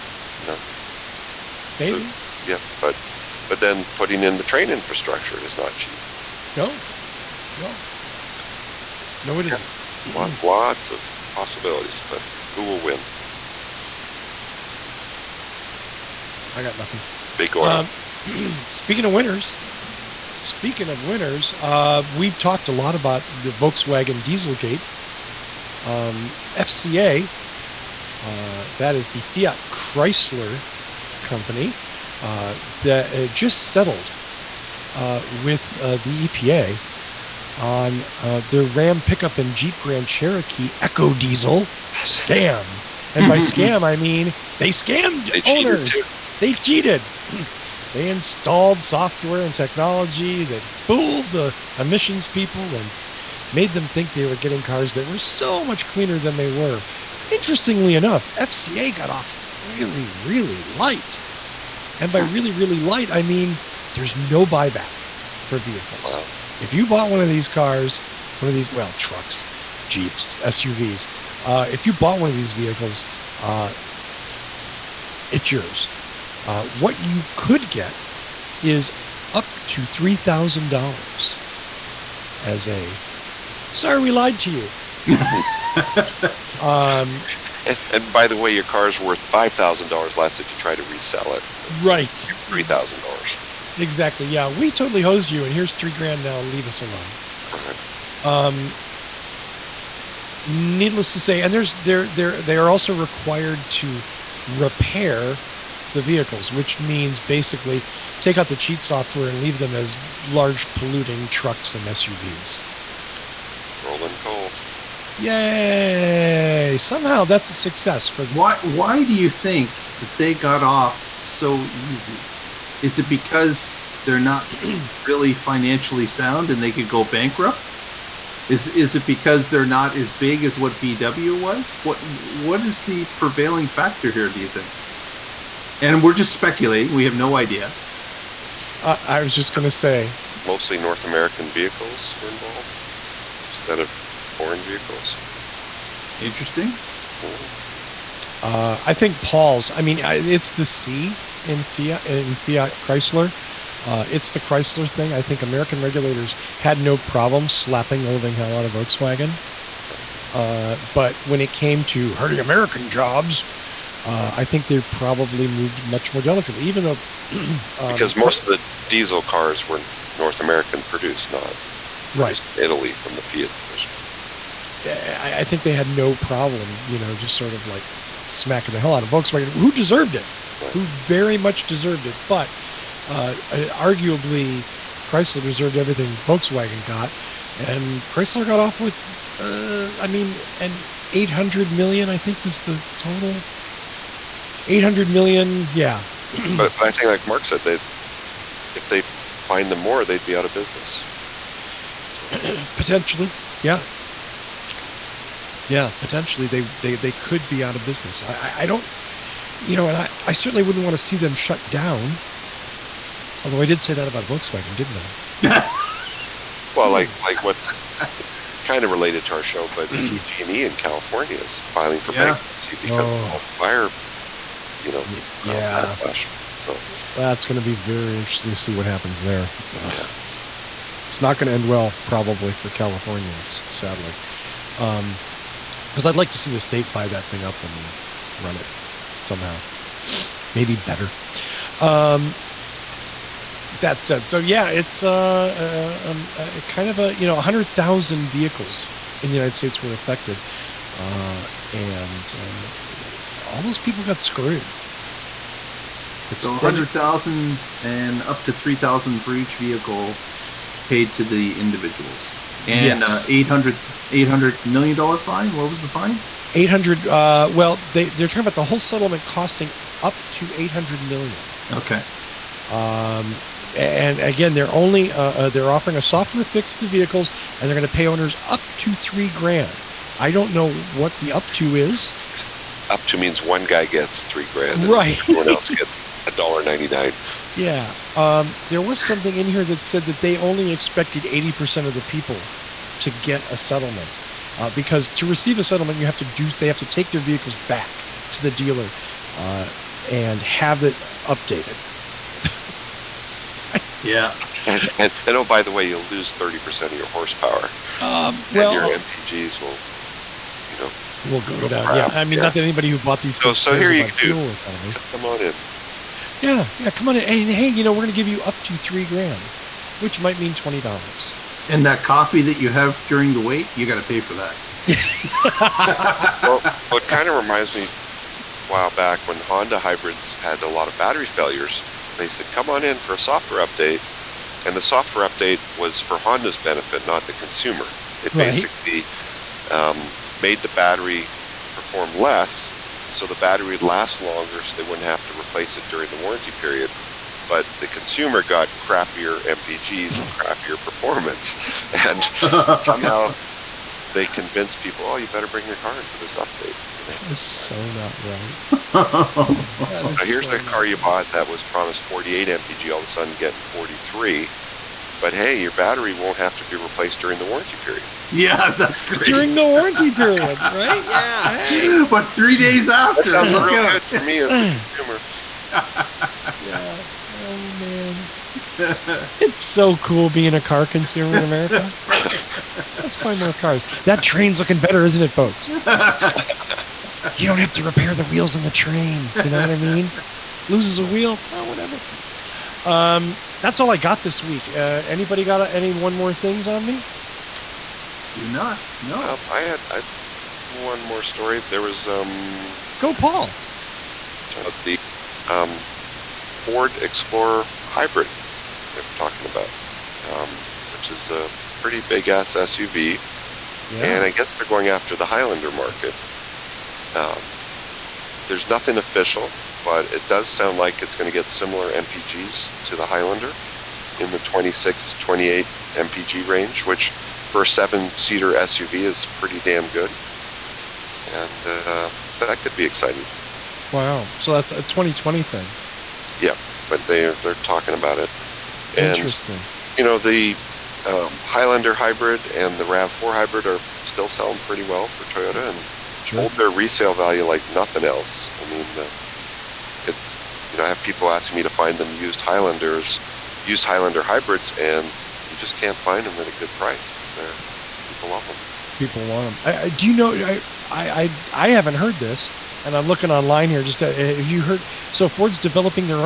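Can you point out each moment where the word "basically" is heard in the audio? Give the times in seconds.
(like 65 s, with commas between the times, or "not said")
107 s, 338 s.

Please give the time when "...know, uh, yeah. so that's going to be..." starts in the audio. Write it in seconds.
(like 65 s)
224 s.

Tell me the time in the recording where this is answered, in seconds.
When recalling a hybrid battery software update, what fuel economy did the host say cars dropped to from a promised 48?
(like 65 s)
363 s.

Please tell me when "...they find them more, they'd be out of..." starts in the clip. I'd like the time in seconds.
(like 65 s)
198 s.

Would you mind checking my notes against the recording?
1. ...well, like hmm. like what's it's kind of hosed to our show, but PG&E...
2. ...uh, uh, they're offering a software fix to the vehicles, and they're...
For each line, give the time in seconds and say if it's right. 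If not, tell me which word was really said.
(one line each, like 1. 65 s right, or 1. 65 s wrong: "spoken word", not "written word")
1. 216 s wrong: "related", not "hosed"
2. 275 s right.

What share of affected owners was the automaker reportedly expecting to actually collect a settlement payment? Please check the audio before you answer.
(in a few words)
80%.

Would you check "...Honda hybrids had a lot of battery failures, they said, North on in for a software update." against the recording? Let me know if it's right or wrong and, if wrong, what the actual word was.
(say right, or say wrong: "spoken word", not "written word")
wrong: "Come", not "North".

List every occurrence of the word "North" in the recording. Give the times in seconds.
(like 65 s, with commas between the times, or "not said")
140 s, 170 s.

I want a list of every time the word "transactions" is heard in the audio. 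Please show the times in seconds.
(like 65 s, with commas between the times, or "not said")
not said.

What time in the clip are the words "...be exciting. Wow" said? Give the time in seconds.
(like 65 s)
432 s.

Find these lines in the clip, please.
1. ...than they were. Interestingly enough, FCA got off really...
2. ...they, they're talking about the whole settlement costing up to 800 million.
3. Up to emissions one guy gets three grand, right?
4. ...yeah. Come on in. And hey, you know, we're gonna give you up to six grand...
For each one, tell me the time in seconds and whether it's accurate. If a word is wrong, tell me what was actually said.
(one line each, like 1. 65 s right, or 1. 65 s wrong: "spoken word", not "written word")
1. 56 s right
2. 267 s right
3. 282 s wrong: "means", not "emissions"
4. 316 s wrong: "three", not "six".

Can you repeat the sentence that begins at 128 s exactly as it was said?
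Is is it because they're not as big as what VW was?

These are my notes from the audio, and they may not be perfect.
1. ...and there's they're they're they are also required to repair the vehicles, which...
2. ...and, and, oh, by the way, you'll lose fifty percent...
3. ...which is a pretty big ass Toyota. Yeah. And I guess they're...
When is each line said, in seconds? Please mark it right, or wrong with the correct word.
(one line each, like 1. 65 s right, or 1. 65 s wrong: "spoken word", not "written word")
1. 101 s right
2. 304 s wrong: "thirty", not "fifty"
3. 410 s wrong: "SUV", not "Toyota".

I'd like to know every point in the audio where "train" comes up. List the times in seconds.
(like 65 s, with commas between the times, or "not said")
4 s, 384 s, 388 s.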